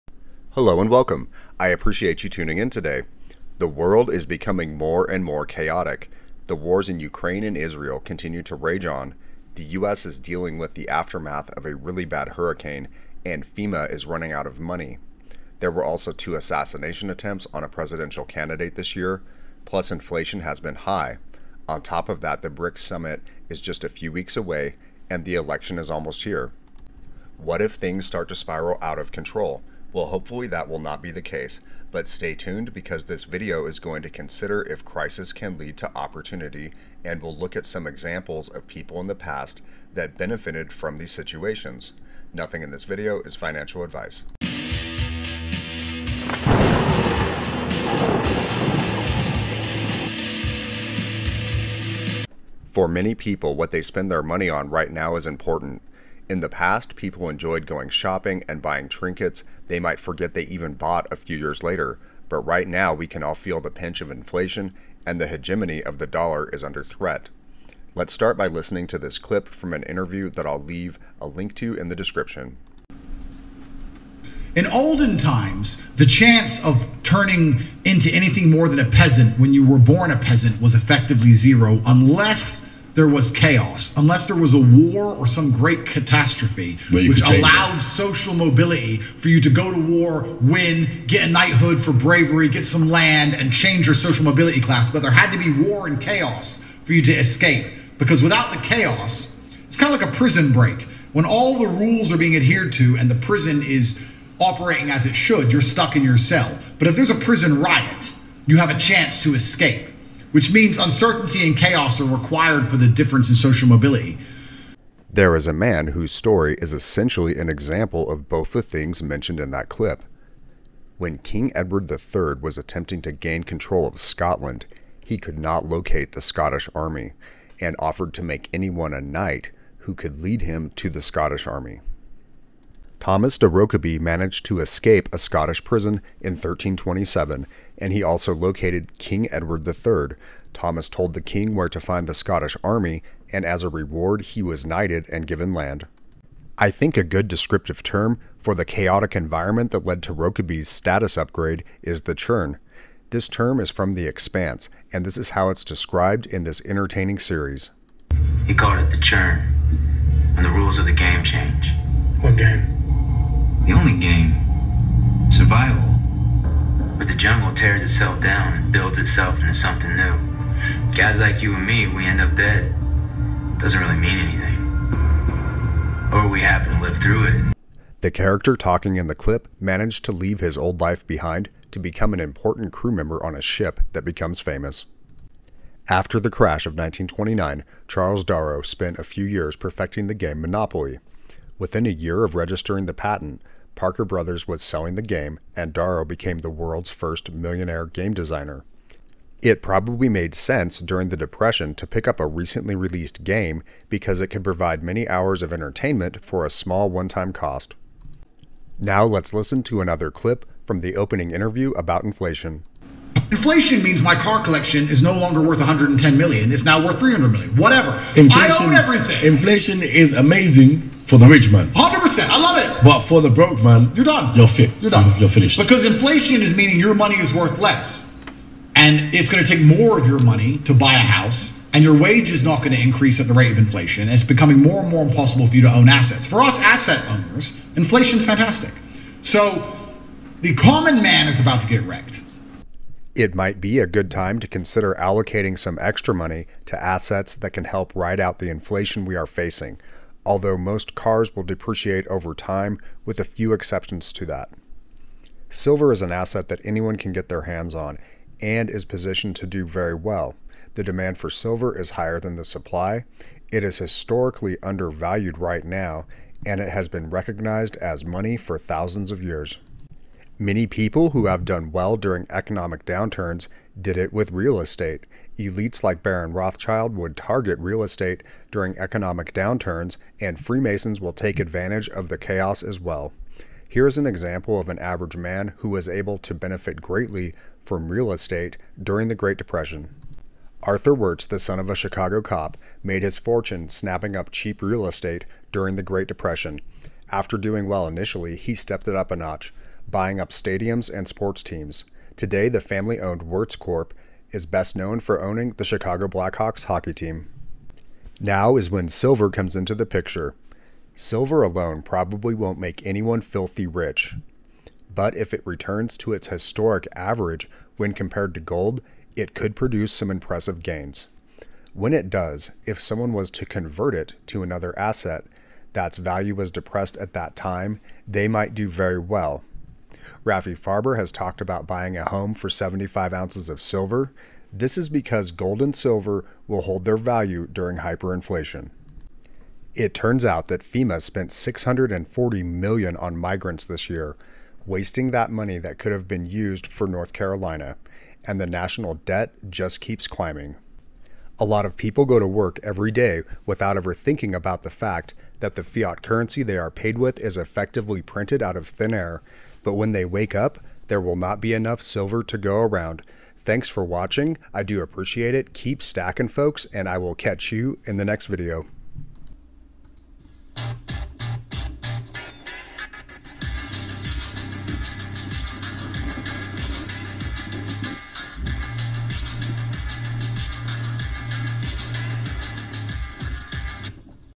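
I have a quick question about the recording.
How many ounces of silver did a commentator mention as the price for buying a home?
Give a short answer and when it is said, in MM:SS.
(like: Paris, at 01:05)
75, at 05:32.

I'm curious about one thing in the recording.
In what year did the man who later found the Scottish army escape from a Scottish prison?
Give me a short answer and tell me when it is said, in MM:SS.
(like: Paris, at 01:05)
1327, at 02:16.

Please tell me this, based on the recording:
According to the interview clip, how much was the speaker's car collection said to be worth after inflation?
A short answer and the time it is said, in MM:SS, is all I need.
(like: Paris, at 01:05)
300 million, at 03:36.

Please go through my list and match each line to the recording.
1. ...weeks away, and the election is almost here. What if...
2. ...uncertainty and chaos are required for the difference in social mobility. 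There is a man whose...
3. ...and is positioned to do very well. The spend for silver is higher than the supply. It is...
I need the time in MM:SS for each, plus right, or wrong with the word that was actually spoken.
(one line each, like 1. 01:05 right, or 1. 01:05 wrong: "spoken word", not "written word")
1. 00:24 right
2. 01:50 right
3. 04:18 wrong: "demand", not "spend".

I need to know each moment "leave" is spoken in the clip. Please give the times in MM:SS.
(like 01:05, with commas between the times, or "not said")
01:10, 03:00.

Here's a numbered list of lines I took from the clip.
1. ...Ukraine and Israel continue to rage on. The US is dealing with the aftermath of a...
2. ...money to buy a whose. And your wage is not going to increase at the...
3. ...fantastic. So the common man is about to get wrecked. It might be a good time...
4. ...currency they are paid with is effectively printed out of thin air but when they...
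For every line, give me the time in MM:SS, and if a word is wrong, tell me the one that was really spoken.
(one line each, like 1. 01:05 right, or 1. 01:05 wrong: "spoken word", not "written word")
1. 00:06 right
2. 03:50 wrong: "house", not "whose"
3. 03:58 right
4. 05:56 right.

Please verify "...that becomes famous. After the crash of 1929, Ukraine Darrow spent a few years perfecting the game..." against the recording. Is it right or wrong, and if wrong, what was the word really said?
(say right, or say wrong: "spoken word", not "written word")
wrong: "Charles", not "Ukraine".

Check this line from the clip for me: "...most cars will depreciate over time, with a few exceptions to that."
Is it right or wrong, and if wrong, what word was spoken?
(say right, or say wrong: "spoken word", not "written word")
right.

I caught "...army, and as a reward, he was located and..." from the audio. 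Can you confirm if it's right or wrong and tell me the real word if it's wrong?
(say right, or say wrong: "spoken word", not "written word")
wrong: "knighted", not "located".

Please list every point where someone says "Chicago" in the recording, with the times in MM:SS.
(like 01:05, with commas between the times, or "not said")
04:51, 05:05.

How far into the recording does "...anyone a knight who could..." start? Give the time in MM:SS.
02:08.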